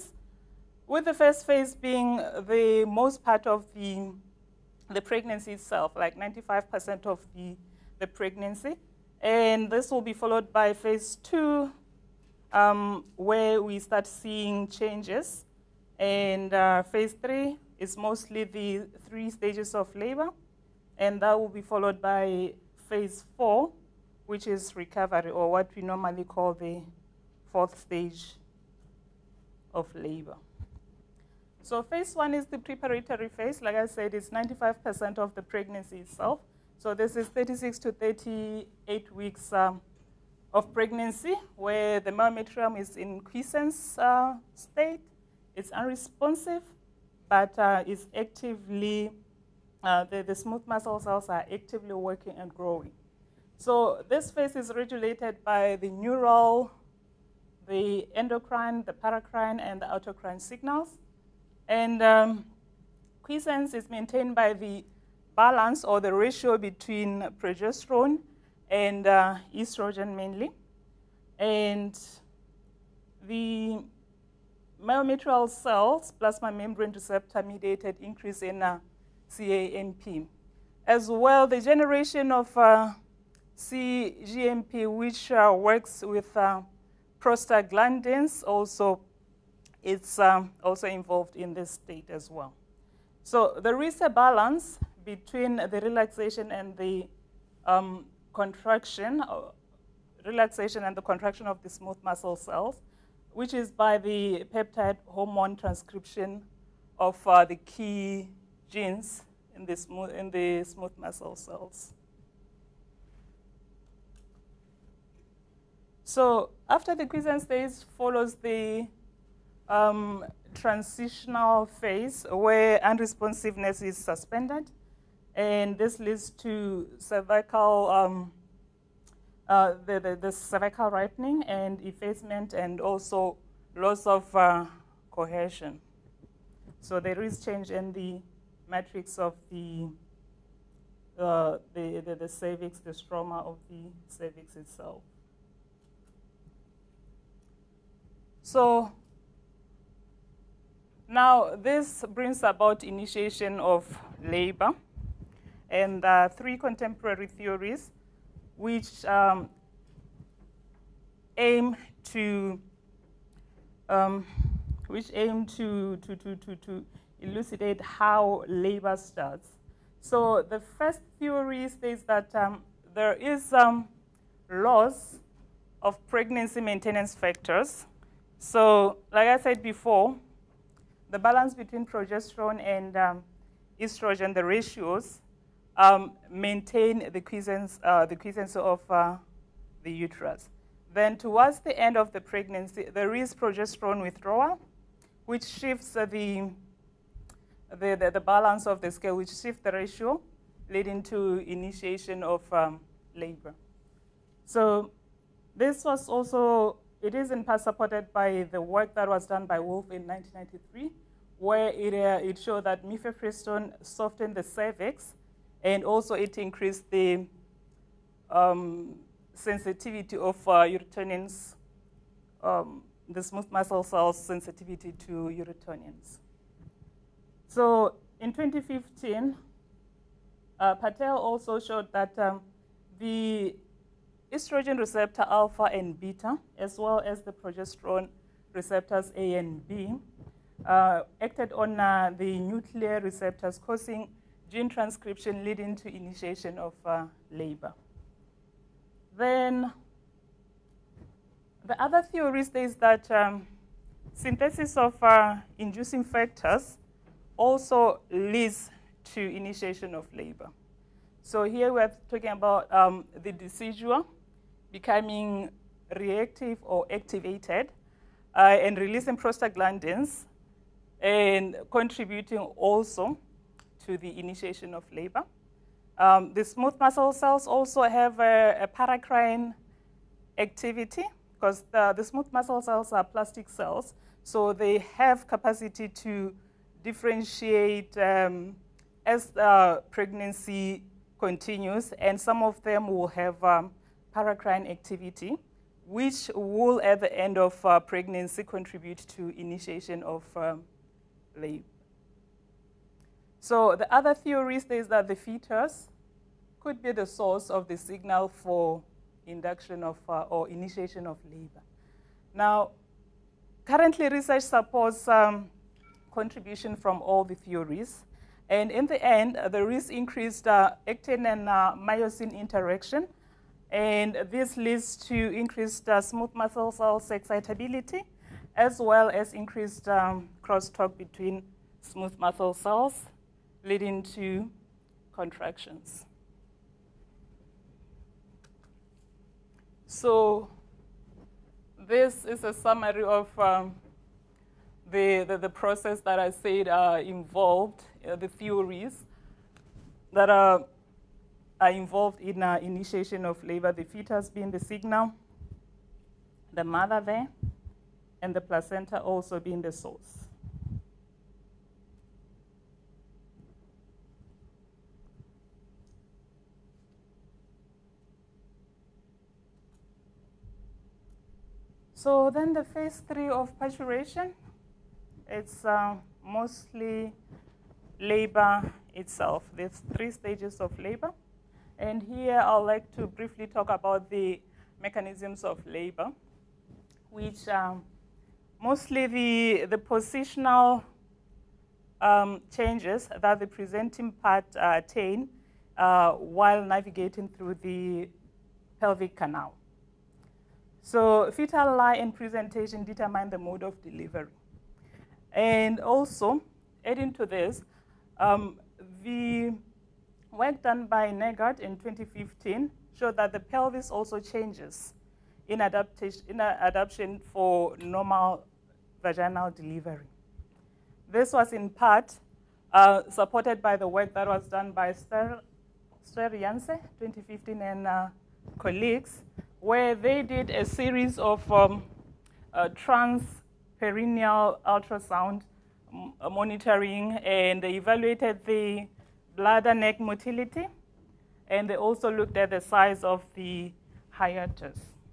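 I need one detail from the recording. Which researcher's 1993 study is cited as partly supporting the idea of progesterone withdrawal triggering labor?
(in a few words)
Wolf.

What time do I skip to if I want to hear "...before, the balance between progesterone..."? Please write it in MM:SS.
02:59.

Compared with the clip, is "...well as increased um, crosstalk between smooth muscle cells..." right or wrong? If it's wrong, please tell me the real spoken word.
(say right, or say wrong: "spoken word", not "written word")
right.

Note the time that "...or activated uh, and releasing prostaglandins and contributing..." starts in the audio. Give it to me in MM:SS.
04:26.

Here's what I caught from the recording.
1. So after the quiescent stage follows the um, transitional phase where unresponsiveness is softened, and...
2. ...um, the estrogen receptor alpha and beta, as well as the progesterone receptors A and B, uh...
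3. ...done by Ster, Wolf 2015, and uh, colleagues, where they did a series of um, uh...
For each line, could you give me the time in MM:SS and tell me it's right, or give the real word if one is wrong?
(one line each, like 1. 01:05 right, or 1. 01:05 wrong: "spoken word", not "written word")
1. 01:56 wrong: "suspended", not "softened"
2. 03:52 right
3. 07:04 wrong: "Ster", not "Wolf".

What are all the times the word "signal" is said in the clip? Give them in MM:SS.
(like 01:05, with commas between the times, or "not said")
01:00, 05:07, 05:54.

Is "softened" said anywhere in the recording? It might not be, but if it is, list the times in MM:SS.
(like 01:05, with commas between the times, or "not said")
03:33.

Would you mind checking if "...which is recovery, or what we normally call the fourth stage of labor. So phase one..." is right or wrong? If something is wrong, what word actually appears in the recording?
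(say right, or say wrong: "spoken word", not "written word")
right.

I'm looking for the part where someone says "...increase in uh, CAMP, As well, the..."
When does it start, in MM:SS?
01:18.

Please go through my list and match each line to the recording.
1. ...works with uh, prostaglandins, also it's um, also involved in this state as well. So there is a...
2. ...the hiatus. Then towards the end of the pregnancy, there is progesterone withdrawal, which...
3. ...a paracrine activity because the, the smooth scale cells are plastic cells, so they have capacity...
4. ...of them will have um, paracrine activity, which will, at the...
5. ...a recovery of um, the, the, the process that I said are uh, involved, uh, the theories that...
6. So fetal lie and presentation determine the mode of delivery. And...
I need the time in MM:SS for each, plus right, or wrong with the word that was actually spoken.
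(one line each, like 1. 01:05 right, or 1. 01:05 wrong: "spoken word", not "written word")
1. 01:25 right
2. 03:09 wrong: "uterus", not "hiatus"
3. 04:38 wrong: "muscle", not "scale"
4. 04:52 right
5. 05:42 wrong: "summary", not "recovery"
6. 06:40 right.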